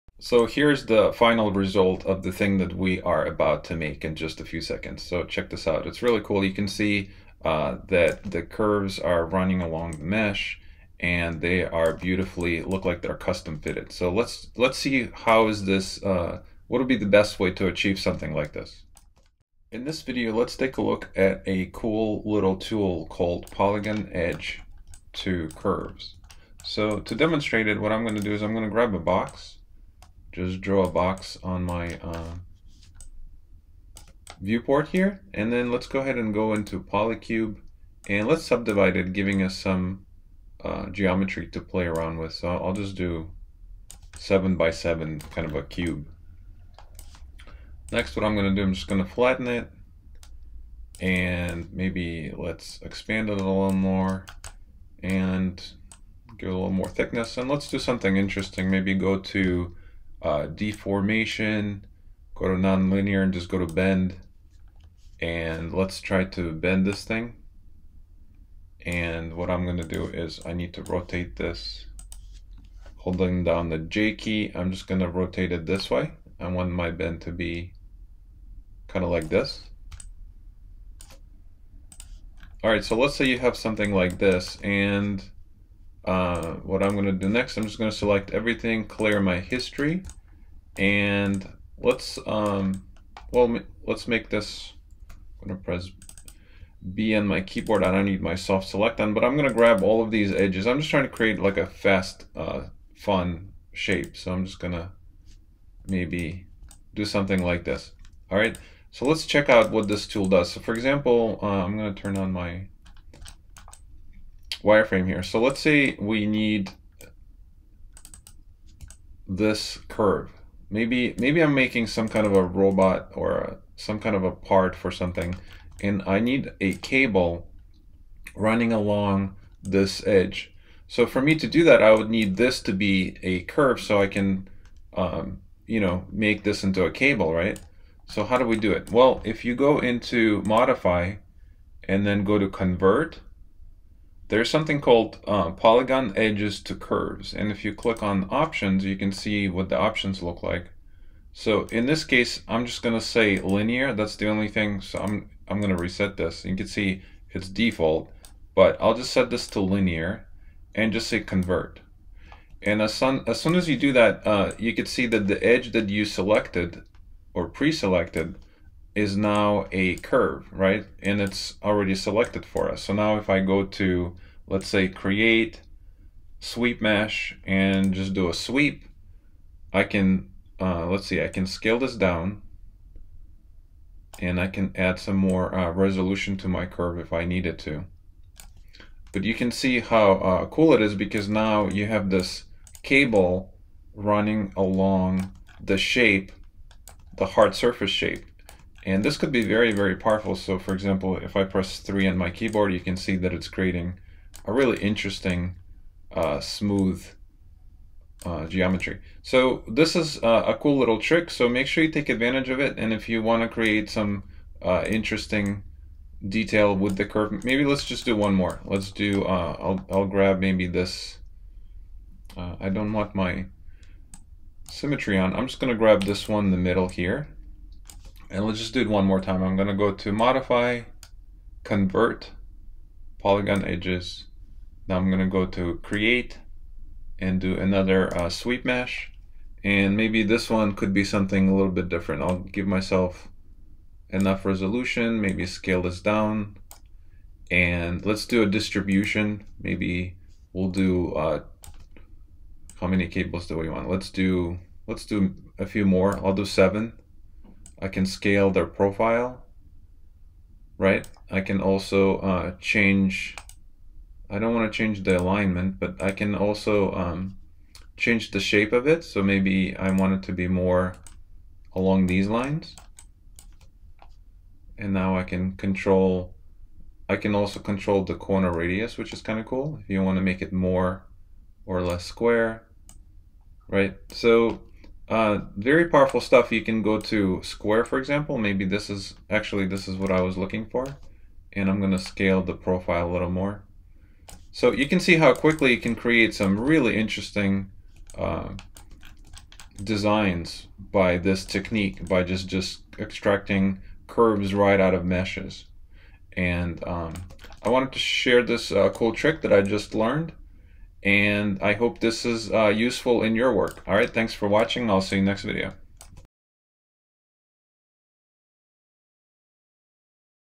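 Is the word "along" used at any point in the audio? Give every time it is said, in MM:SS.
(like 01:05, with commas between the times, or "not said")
00:09, 02:08, 03:14, 04:31.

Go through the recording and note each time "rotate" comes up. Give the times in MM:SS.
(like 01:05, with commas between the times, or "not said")
01:10, 01:15.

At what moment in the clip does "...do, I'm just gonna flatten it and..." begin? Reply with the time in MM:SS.
00:48.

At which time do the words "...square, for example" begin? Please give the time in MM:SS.
04:47.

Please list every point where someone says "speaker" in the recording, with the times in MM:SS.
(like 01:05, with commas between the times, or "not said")
not said.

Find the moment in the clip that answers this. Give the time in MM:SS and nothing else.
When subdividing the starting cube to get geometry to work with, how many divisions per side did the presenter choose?
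00:44.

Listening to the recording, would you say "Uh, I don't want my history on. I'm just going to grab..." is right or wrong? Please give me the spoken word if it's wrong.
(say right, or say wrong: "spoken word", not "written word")
wrong: "symmetry", not "history".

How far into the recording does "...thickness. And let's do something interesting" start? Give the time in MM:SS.
00:56.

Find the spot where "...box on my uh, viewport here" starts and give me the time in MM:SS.
00:30.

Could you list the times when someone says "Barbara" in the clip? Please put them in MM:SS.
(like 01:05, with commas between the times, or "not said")
not said.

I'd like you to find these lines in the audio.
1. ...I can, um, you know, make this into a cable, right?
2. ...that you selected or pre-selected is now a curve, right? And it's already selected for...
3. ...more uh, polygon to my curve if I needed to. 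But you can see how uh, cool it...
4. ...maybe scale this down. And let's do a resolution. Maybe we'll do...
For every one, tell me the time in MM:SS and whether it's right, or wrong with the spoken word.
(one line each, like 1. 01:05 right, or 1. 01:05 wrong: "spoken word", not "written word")
1. 02:14 right
2. 02:45 right
3. 03:05 wrong: "resolution", not "polygon"
4. 04:05 wrong: "distribution", not "resolution".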